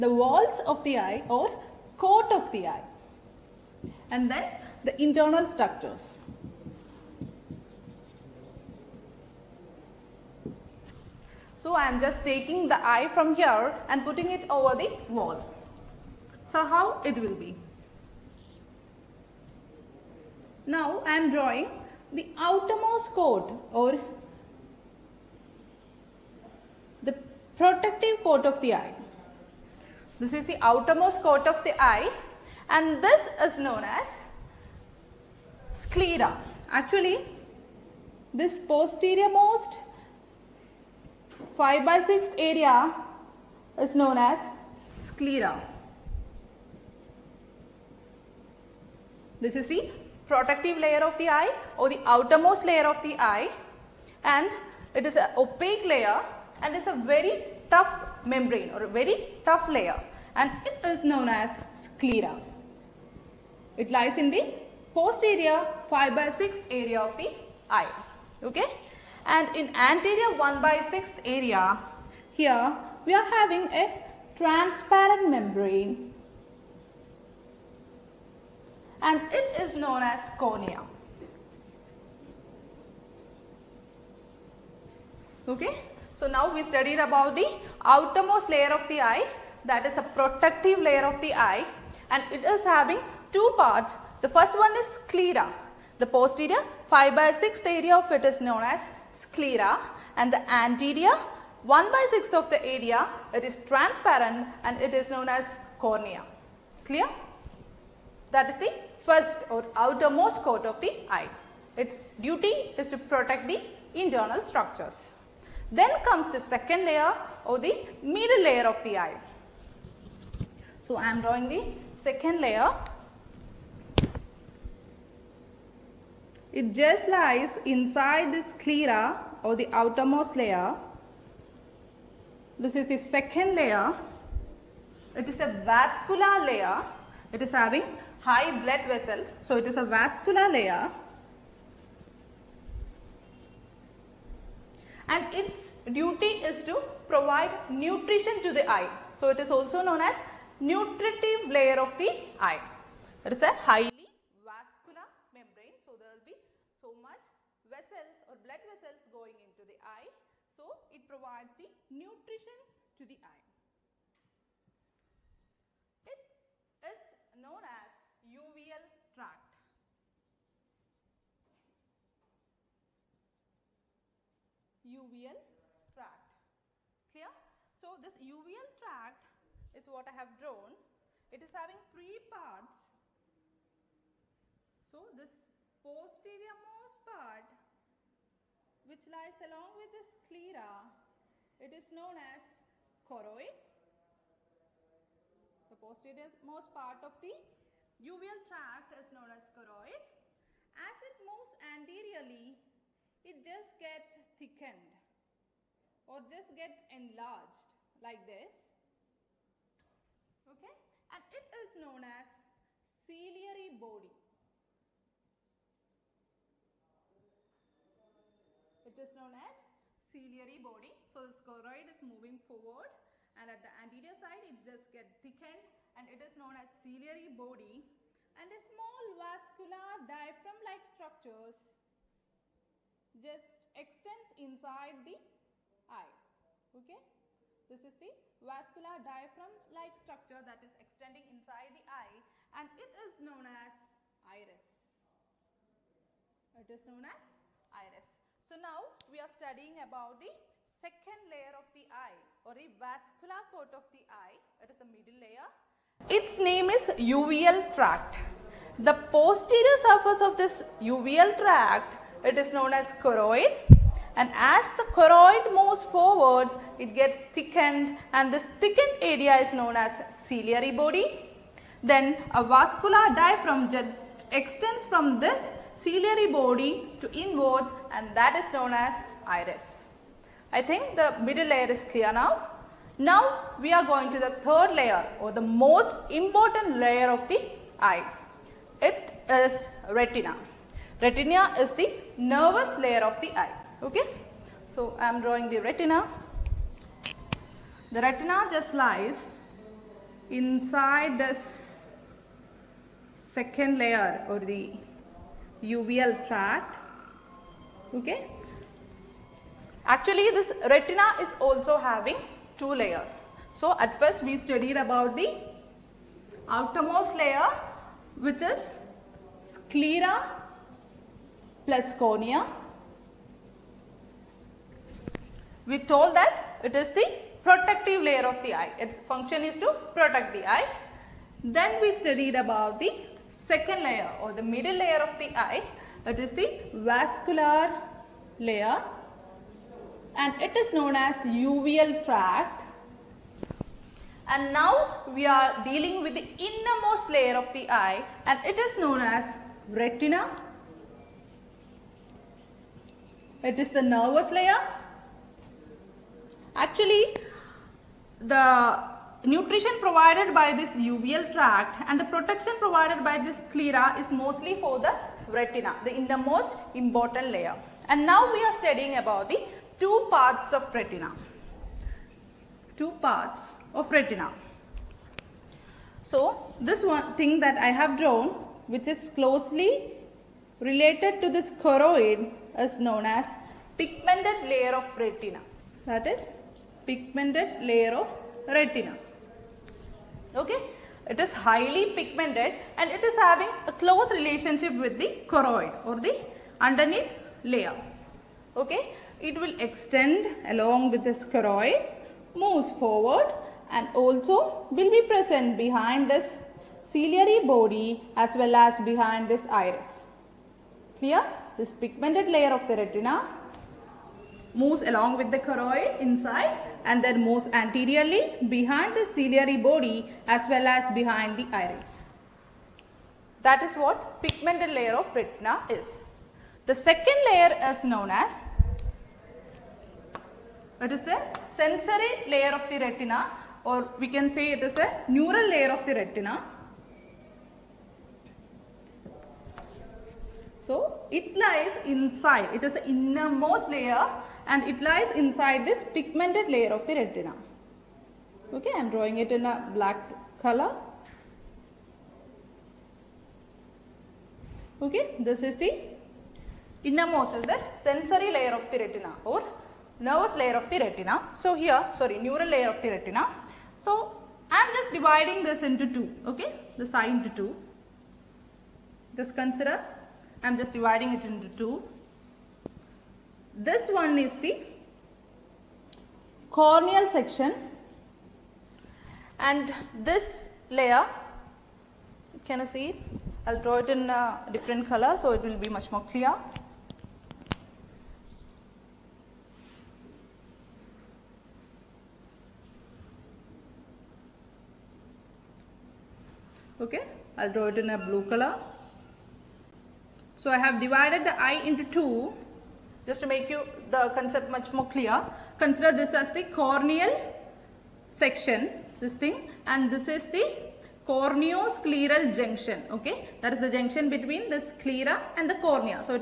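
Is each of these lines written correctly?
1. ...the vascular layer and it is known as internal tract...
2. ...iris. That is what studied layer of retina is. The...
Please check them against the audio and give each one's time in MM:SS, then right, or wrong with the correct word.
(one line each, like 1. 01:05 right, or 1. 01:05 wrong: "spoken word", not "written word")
1. 05:36 wrong: "uveal", not "internal"
2. 07:01 wrong: "pigmented", not "studied".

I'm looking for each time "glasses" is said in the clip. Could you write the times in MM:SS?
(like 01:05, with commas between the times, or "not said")
not said.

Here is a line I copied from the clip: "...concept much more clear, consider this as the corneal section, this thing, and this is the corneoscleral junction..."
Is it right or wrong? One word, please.
right.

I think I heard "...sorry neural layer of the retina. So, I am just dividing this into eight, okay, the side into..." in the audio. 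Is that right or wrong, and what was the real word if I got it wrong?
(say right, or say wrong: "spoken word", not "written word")
wrong: "two", not "eight".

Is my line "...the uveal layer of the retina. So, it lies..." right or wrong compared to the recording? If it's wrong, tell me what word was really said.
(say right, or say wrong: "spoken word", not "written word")
wrong: "neural", not "uveal".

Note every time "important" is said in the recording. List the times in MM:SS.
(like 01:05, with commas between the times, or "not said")
04:46, 06:06.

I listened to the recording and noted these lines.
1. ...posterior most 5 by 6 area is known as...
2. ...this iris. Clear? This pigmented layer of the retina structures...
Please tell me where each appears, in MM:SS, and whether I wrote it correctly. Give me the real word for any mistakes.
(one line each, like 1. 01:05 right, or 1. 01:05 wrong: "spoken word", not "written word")
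1. 00:38 right
2. 06:49 wrong: "moves", not "structures".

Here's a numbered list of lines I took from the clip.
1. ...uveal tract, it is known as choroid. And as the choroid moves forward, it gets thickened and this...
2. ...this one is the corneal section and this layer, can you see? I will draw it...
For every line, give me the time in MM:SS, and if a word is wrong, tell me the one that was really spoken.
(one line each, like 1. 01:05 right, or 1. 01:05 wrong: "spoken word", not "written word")
1. 04:20 right
2. 07:53 right.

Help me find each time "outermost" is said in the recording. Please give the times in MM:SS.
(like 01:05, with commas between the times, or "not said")
00:22, 00:30, 00:52, 01:27, 01:49, 02:09, 05:16.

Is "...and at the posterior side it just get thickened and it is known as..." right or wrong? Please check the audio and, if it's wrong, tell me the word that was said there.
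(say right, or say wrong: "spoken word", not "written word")
wrong: "anterior", not "posterior".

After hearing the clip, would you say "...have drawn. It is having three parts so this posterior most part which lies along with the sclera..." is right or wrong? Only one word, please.
right.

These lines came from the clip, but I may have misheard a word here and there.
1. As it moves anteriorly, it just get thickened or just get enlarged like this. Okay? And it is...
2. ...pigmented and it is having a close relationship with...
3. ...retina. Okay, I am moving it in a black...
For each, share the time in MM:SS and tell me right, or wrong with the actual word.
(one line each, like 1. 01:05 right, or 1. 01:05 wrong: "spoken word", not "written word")
1. 03:20 right
2. 06:31 right
3. 07:26 wrong: "drawing", not "moving".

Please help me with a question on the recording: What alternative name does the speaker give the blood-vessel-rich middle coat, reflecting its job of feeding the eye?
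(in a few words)
nutritive layer.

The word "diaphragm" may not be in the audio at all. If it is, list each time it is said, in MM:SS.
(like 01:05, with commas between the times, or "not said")
03:50, 03:59, 04:33.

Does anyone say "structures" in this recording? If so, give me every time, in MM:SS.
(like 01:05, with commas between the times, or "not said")
00:05, 01:54, 03:50, 03:59.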